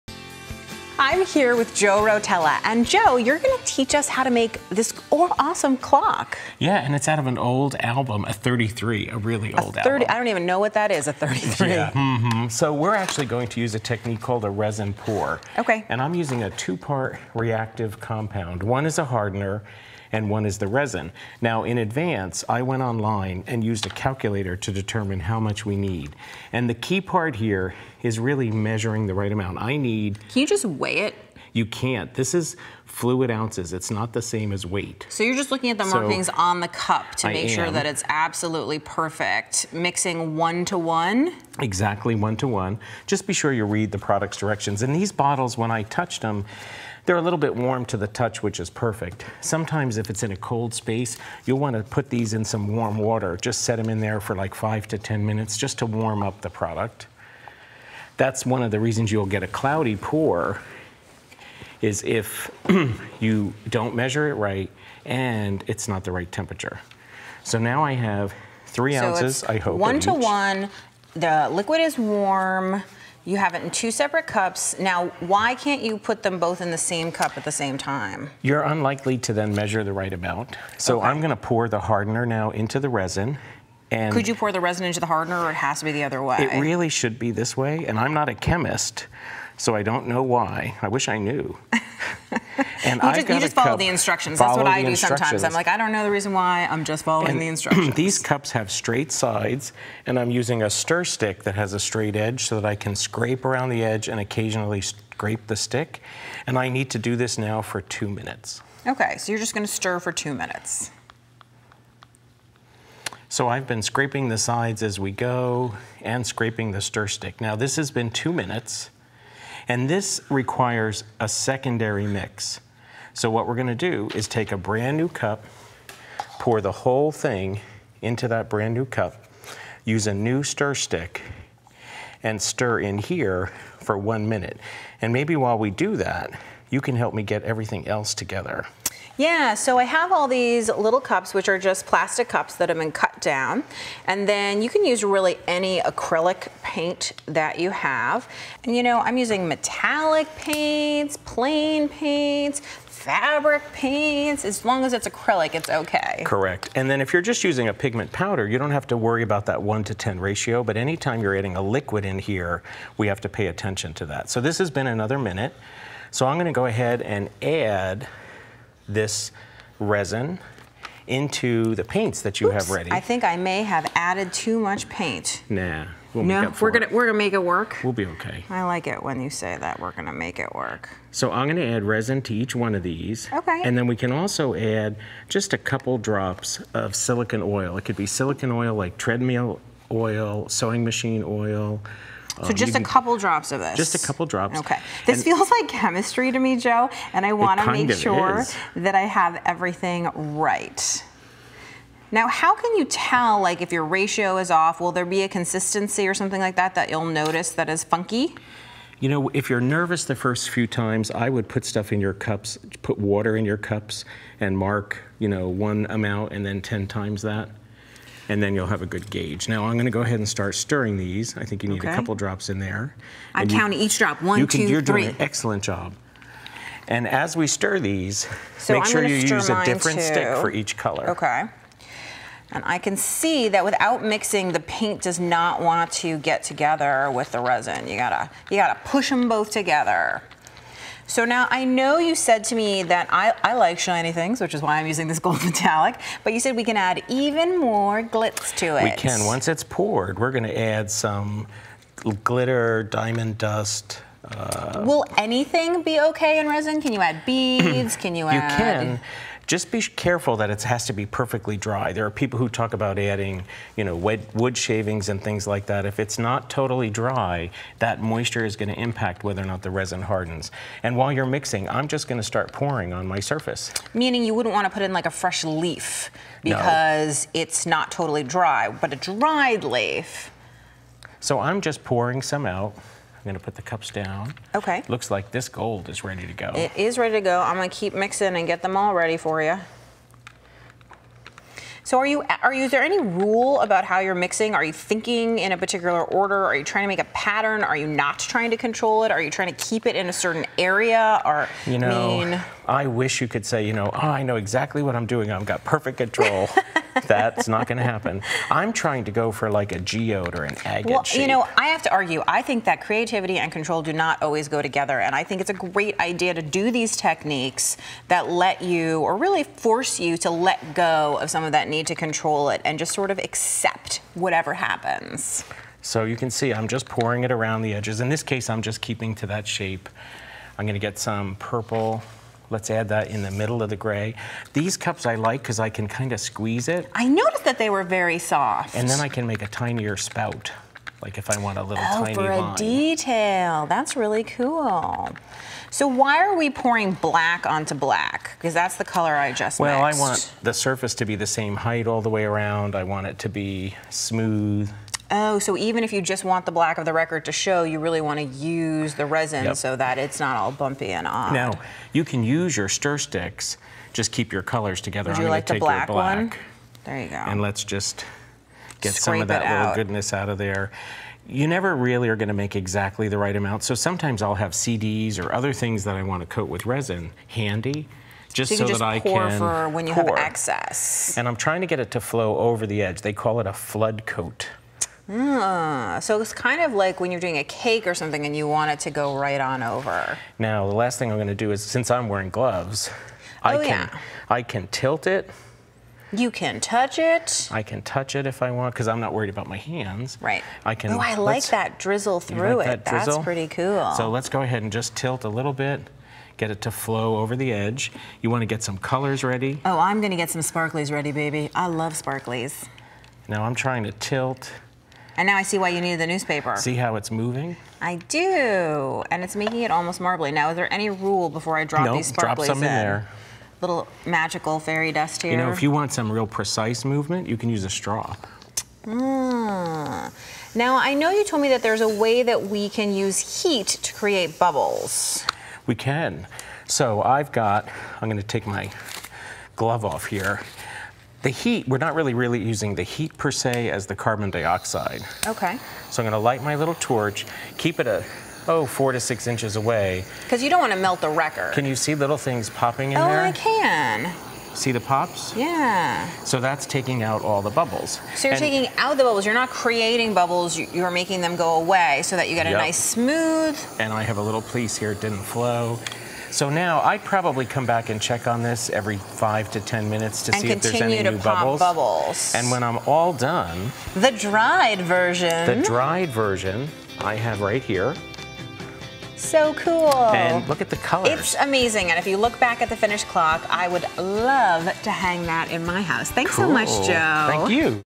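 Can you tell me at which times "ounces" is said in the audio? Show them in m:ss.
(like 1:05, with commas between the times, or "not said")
0:33, 1:09.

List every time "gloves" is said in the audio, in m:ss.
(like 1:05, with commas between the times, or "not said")
6:32, 7:19.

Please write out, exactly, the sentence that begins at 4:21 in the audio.
There are people who talk about adding, you know, wood shavings and things like that.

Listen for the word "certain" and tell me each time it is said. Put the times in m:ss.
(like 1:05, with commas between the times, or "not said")
5:00.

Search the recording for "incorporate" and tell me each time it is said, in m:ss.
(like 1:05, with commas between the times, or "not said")
not said.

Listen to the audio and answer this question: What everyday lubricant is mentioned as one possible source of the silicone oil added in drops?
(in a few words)
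treadmill oil.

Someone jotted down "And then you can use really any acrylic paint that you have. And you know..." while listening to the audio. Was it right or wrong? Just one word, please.
right.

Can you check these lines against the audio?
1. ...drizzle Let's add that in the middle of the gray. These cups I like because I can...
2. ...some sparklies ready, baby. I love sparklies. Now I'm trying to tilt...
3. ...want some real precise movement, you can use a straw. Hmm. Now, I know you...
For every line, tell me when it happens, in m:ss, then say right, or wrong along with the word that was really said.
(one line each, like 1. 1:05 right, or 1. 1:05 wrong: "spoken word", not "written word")
1. 5:31 wrong: "purple", not "drizzle"
2. 6:50 right
3. 7:05 right.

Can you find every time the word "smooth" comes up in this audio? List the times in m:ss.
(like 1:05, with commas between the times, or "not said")
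5:53, 7:42.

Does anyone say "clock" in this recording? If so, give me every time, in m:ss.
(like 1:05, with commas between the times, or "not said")
0:05, 8:03.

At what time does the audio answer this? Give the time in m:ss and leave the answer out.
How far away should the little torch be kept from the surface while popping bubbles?
7:28.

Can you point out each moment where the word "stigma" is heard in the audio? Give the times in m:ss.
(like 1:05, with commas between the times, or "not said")
not said.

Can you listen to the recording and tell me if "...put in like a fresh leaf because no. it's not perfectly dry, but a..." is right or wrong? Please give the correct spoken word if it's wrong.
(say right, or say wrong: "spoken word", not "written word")
wrong: "totally", not "perfectly".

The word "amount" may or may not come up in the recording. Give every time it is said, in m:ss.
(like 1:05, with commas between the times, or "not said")
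0:29, 1:20, 3:35, 6:13.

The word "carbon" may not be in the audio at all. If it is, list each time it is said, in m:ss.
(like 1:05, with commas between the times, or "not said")
7:23.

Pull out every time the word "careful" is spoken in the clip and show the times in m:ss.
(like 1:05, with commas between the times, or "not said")
4:19.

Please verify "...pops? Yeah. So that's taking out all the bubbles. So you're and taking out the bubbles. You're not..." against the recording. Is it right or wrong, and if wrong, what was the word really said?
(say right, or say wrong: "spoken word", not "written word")
right.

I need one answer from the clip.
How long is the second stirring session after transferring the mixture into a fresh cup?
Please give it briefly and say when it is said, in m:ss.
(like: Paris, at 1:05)
1 minute, at 2:13.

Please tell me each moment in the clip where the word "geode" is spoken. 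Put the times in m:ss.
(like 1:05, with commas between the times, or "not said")
5:09.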